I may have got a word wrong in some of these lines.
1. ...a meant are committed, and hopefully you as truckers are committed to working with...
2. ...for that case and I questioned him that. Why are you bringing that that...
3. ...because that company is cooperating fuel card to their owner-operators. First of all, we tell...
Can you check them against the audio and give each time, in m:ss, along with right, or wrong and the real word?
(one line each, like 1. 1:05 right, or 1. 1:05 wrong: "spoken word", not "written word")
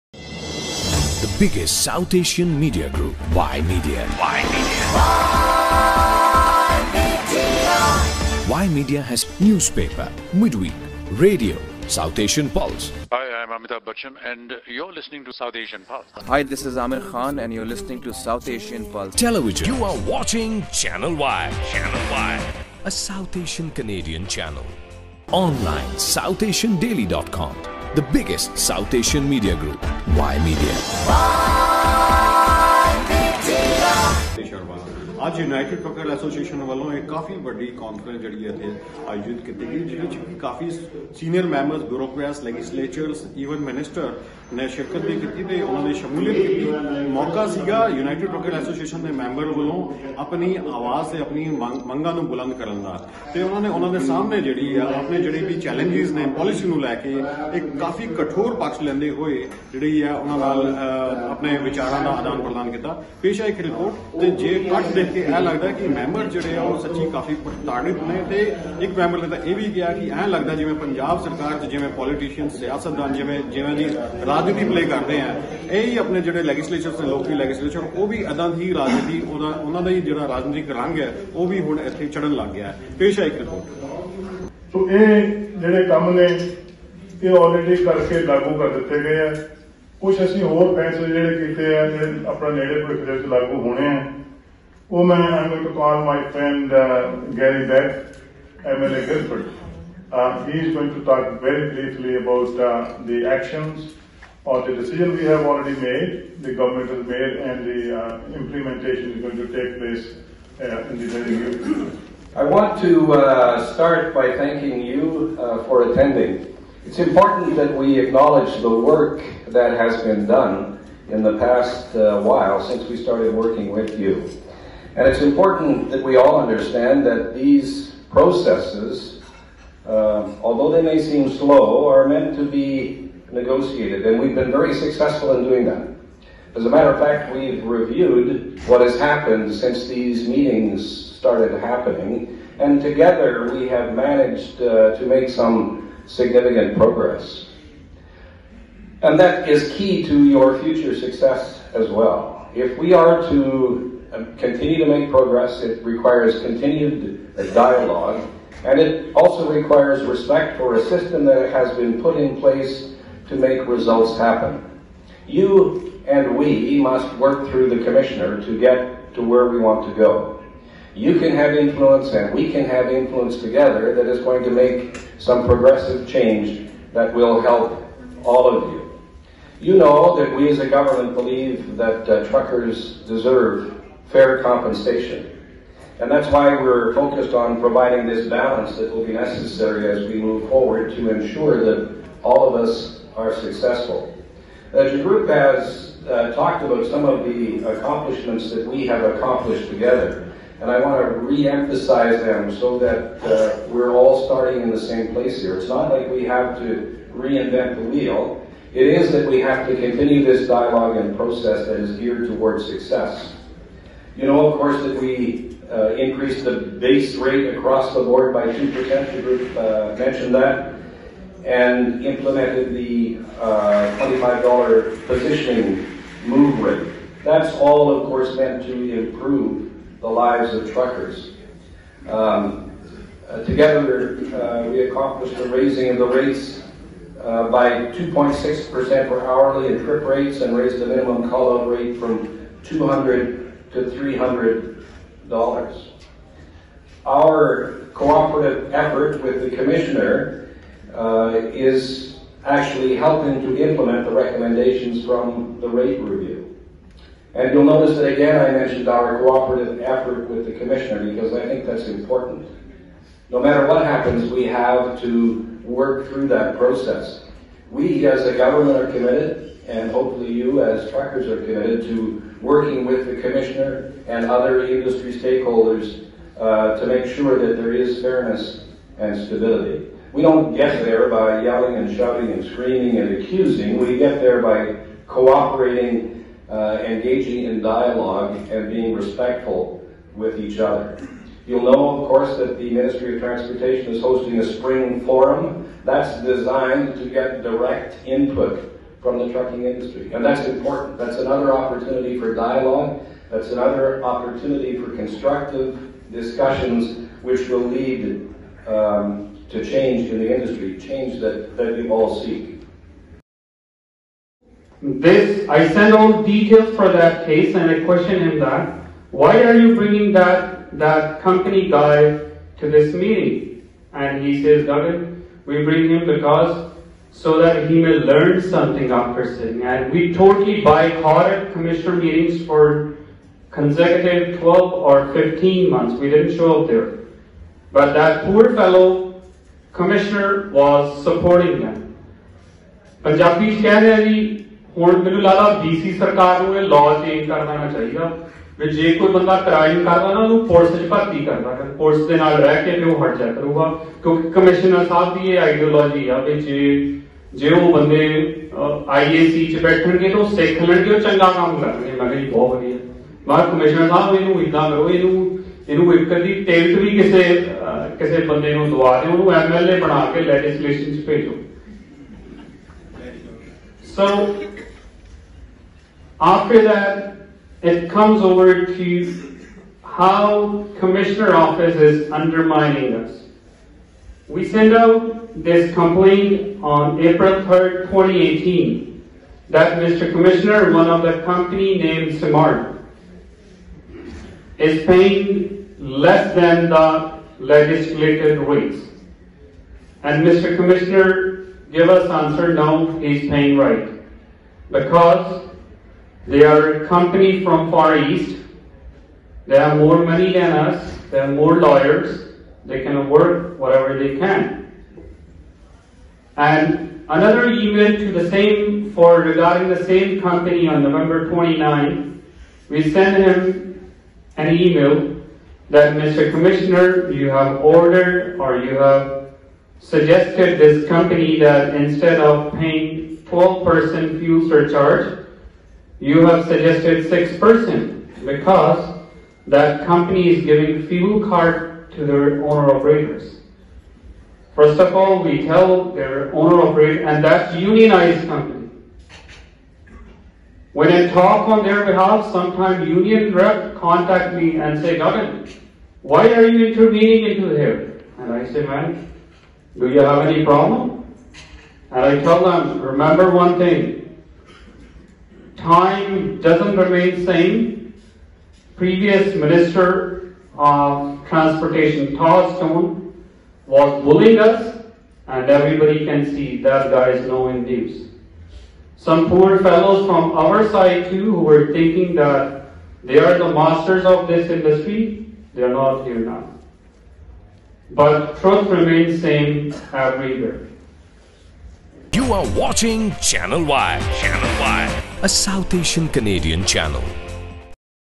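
1. 4:28 wrong: "government", not "meant"
2. 5:16 right
3. 7:18 wrong: "giving", not "cooperating".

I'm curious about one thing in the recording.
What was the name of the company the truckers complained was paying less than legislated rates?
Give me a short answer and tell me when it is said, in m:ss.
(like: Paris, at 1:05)
Smart, at 6:32.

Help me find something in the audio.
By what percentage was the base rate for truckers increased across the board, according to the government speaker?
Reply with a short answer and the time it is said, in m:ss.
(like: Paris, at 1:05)
2%, at 3:38.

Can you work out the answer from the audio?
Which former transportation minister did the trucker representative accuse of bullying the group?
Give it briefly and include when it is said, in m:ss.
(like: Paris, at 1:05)
Thomas Stone, at 7:52.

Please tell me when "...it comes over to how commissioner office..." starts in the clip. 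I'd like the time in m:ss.
6:17.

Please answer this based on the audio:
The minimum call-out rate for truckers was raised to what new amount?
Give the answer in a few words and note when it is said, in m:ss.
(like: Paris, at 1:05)
$300, at 4:03.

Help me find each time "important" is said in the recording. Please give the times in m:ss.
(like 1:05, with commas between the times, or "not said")
1:56, 2:05, 4:21, 5:00.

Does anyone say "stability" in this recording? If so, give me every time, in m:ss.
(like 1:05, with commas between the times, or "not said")
4:39.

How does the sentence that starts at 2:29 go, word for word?
And that is key to your future success as well.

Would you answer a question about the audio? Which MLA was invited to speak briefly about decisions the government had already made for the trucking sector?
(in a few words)
Garry Begg.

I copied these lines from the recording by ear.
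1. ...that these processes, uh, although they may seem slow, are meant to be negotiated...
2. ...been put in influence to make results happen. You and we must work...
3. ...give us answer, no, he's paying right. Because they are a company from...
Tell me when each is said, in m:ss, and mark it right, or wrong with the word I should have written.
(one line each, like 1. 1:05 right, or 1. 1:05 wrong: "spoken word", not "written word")
1. 2:07 right
2. 2:41 wrong: "place", not "influence"
3. 6:41 right.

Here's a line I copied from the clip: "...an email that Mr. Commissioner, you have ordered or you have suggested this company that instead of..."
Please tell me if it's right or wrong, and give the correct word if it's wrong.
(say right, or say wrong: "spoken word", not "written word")
right.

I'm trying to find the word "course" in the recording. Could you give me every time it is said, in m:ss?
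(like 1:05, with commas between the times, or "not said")
3:34, 3:48, 4:52.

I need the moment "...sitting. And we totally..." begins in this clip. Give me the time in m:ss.
5:29.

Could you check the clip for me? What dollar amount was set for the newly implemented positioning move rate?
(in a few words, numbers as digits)
$25.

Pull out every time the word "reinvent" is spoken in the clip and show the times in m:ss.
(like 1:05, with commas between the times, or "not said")
3:27.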